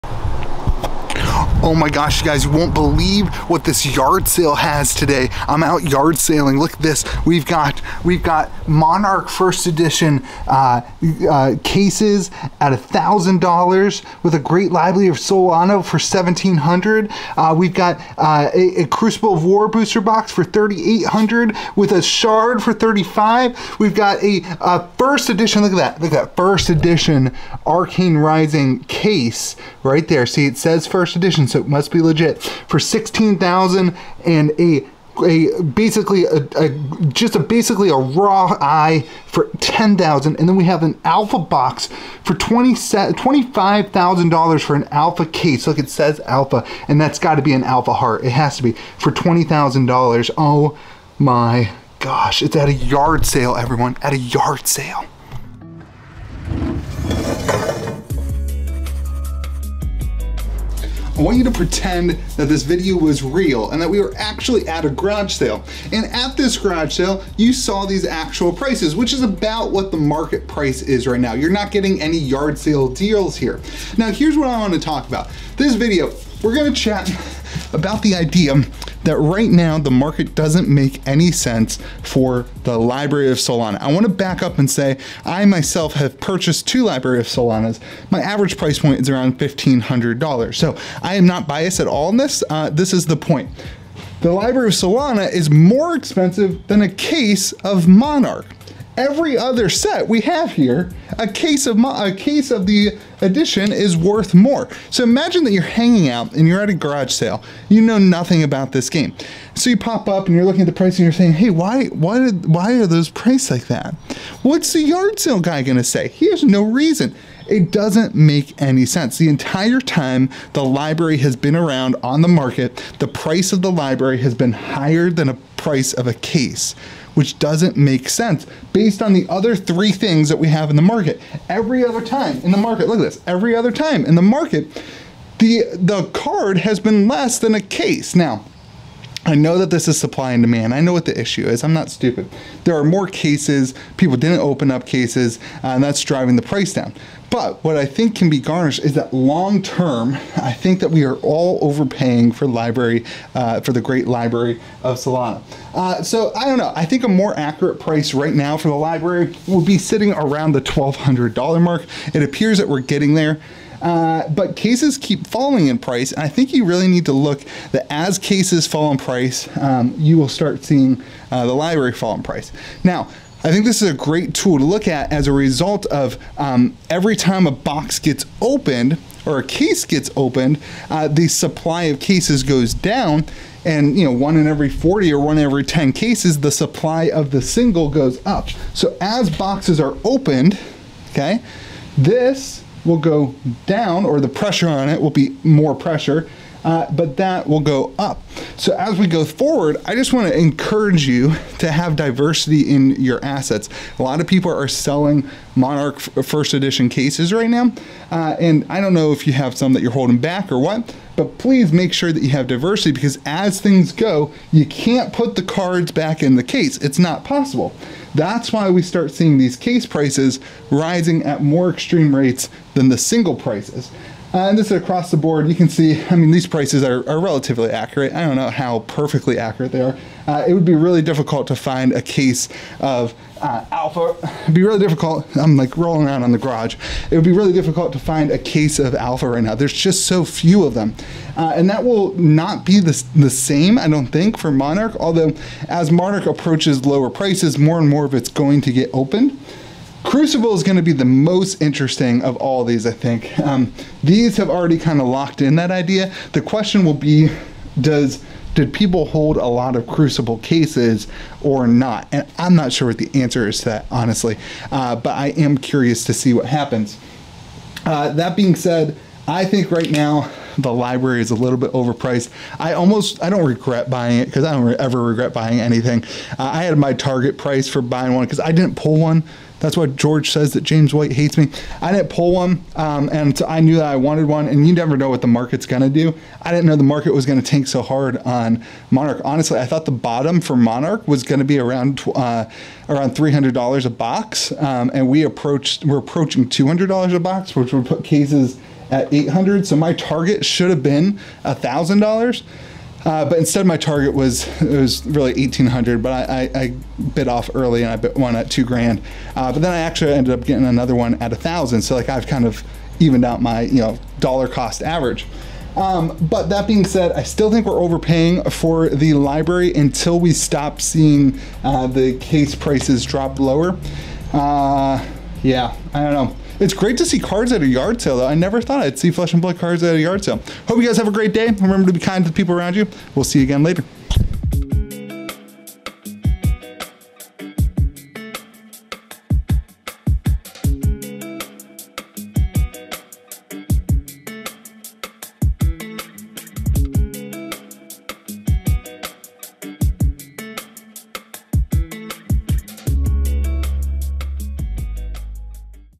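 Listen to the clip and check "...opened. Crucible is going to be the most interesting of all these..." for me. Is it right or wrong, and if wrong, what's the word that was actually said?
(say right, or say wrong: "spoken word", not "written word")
right.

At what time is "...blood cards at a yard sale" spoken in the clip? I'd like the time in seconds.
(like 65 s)
329 s.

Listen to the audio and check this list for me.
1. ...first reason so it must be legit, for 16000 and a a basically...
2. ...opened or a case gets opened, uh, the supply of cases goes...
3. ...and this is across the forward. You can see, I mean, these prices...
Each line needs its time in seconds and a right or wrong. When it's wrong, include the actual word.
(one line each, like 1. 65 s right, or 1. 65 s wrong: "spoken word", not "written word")
1. 30 s wrong: "edition", not "reason"
2. 178 s right
3. 224 s wrong: "board", not "forward".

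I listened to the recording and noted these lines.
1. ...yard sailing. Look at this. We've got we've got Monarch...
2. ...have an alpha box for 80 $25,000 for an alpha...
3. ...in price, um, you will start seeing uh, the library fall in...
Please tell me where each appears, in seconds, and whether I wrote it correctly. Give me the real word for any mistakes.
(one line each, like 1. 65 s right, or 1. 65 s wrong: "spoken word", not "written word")
1. 5 s right
2. 40 s wrong: "20", not "80"
3. 168 s right.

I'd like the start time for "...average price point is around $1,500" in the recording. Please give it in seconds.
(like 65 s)
88 s.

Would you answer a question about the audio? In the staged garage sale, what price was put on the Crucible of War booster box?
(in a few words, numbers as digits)
$3,800.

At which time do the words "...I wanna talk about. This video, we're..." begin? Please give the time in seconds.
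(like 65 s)
74 s.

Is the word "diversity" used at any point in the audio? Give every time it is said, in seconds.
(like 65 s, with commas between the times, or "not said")
201 s, 212 s.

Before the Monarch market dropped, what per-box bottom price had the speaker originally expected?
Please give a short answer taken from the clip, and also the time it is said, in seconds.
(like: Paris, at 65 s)
$300, at 293 s.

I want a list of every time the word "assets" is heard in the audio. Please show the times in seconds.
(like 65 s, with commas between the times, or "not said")
203 s.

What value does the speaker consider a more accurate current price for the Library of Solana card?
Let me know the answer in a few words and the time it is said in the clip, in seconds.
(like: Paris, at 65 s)
$1,200, at 160 s.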